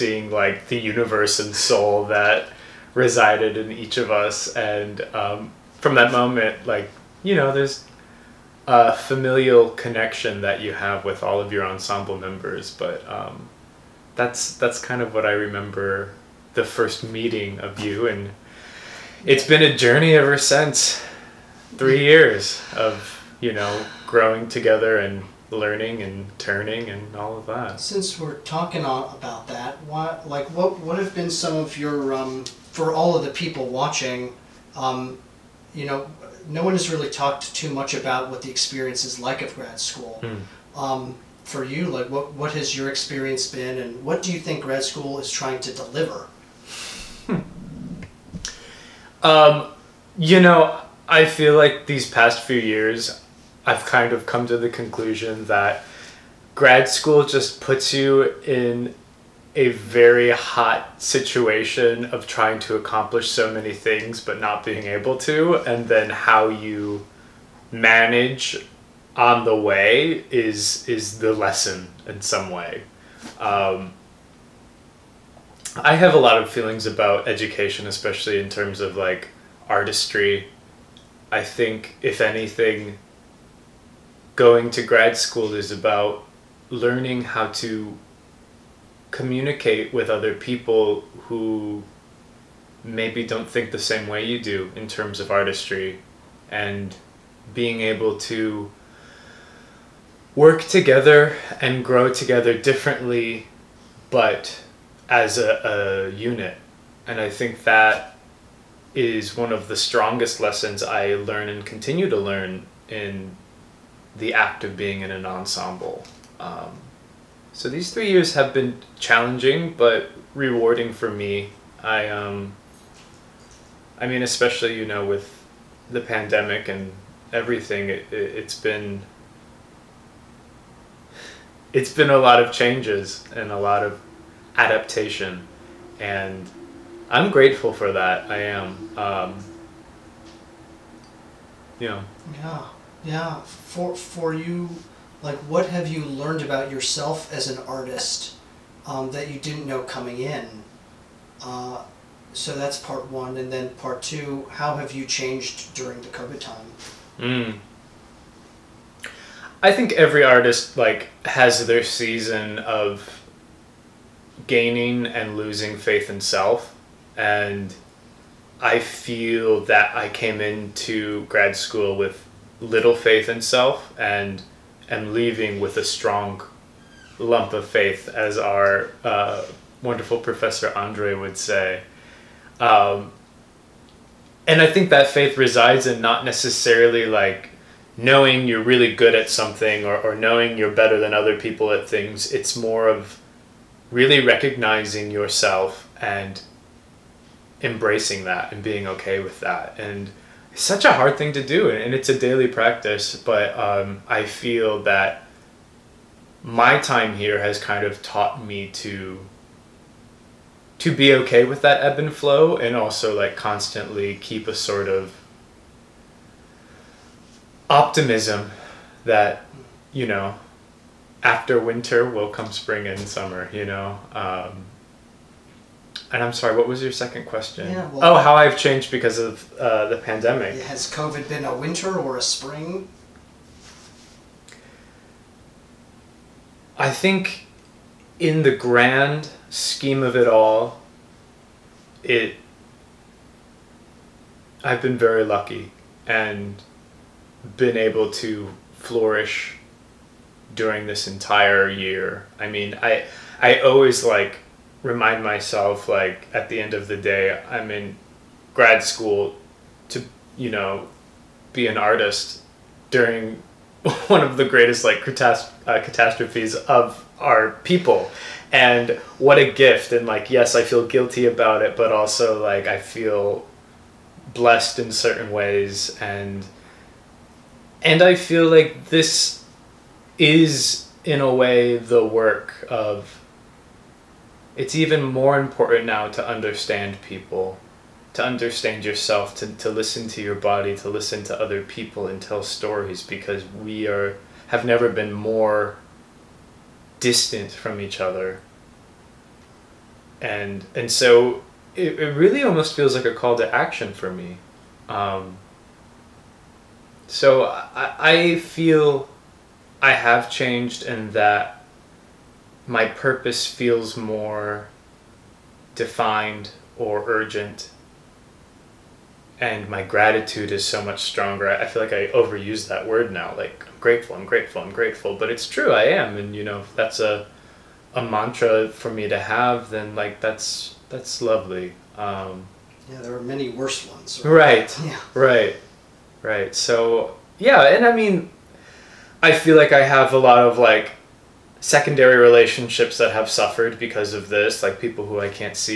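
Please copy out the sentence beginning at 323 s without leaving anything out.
Like I'm grateful, I'm grateful, I'm grateful.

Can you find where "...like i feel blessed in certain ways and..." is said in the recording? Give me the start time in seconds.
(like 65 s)
272 s.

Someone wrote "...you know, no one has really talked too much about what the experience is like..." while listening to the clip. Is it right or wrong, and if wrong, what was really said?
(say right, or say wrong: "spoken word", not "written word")
right.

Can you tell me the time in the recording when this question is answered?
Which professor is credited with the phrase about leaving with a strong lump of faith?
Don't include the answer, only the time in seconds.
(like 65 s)
180 s.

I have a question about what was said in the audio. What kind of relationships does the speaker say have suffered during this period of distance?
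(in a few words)
secondary relationships.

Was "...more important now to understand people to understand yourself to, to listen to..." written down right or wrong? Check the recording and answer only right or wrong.
right.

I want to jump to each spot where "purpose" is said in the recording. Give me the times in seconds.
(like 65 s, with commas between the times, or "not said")
312 s.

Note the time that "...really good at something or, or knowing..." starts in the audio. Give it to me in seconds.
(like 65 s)
188 s.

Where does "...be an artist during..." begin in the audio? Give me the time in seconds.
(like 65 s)
261 s.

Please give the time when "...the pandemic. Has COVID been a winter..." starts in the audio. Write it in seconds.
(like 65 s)
229 s.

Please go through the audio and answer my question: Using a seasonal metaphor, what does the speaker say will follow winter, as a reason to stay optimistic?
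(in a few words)
spring and summer.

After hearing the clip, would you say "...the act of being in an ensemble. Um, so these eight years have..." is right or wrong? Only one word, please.
wrong.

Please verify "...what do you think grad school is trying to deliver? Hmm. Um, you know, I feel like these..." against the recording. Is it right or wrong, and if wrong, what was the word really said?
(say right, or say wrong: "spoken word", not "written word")
right.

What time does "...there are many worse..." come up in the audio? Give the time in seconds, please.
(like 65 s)
332 s.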